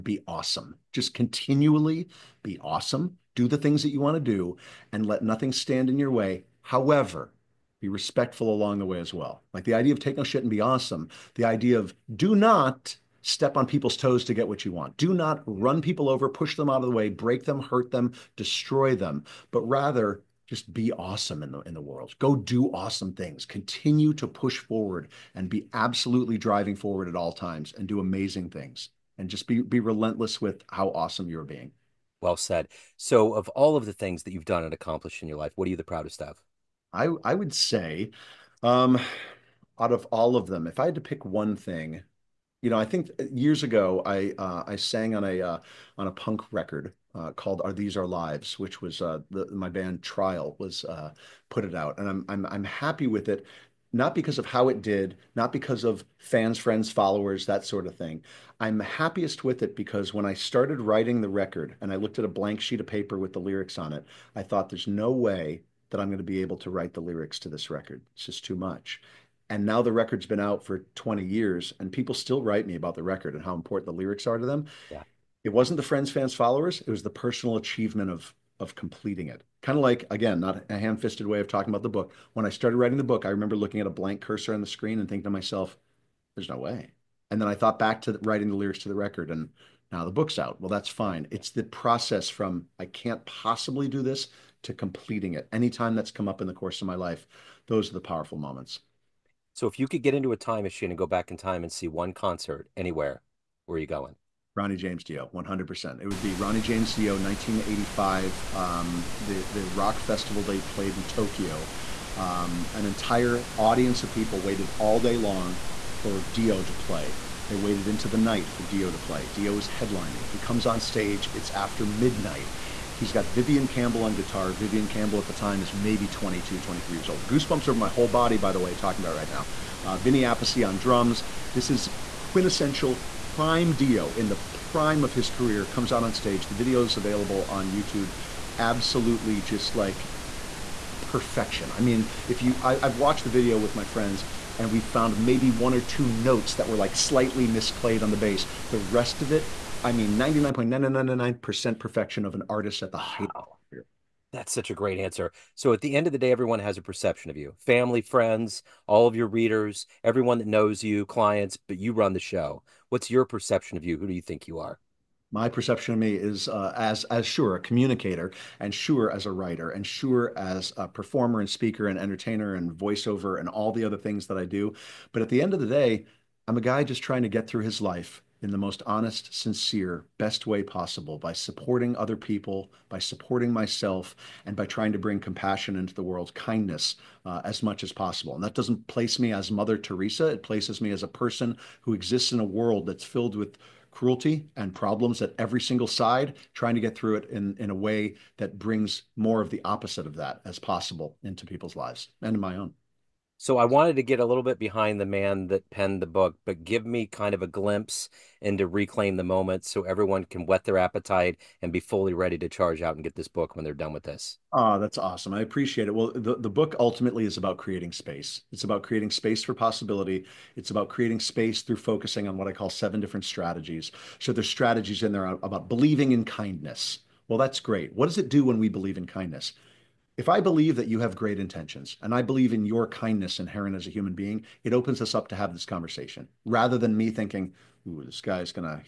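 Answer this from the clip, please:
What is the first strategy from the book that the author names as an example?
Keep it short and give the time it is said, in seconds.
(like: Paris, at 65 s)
Believing in kindness, at 225 s.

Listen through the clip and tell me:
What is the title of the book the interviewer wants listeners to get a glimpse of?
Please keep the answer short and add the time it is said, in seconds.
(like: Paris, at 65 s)
Reclaim the Moment, at 208 s.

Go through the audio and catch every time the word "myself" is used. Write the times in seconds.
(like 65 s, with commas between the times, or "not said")
85 s, 183 s.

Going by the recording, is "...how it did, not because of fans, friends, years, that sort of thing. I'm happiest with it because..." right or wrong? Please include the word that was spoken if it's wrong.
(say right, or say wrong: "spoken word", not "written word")
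wrong: "followers", not "years".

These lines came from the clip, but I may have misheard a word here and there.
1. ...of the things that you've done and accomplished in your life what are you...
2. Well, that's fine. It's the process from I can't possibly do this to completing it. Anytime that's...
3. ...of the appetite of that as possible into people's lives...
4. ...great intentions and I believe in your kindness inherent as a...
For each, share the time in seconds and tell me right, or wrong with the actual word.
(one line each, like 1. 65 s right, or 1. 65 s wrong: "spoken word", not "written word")
1. 33 s right
2. 90 s right
3. 199 s wrong: "opposite", not "appetite"
4. 231 s right.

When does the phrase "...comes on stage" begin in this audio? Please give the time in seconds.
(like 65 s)
120 s.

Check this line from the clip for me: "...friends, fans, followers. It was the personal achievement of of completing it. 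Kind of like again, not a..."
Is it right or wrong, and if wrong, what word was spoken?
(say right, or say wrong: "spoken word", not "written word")
right.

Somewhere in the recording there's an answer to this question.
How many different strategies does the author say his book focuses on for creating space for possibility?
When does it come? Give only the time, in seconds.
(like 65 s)
222 s.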